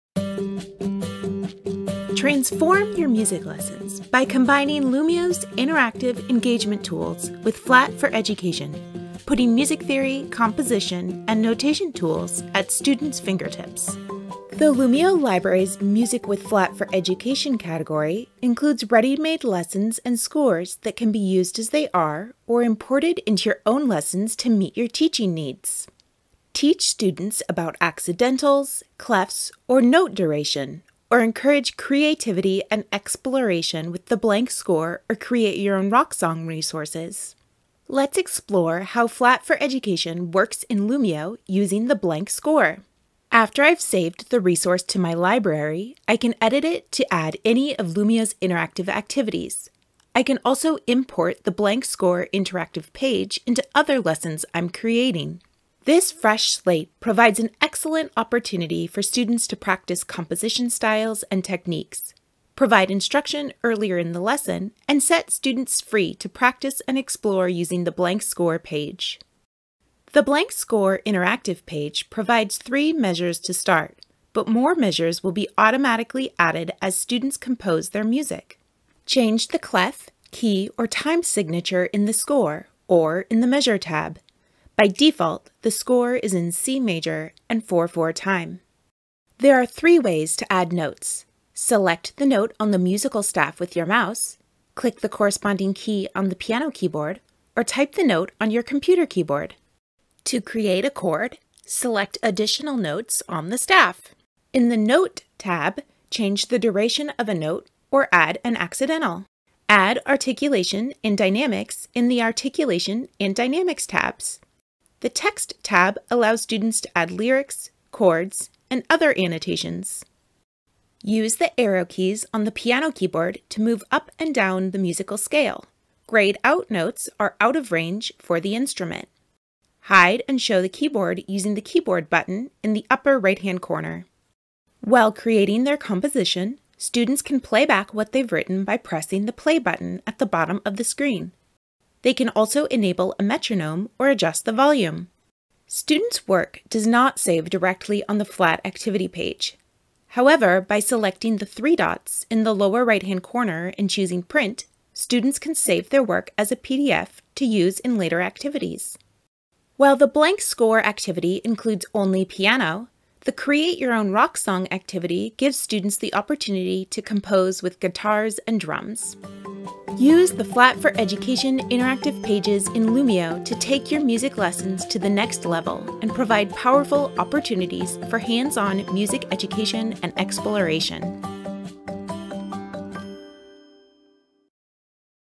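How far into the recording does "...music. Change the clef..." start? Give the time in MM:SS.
01:18.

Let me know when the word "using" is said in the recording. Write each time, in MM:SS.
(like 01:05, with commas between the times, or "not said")
00:41, 01:07, 02:11.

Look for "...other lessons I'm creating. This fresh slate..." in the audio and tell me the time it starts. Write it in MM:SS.
00:53.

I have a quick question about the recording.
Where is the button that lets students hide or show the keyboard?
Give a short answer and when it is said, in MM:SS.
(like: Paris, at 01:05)
Upper right-hand corner, at 02:12.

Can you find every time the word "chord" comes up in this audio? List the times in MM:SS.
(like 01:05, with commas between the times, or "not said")
01:40, 01:57.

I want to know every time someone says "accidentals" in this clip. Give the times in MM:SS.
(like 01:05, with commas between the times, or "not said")
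00:27, 01:48.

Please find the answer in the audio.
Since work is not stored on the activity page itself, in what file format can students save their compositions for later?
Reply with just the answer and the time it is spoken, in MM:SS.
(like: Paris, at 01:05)
PDF, at 02:36.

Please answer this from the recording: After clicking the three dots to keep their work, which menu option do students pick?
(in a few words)
Print.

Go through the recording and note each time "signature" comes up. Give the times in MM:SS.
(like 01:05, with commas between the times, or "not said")
01:21.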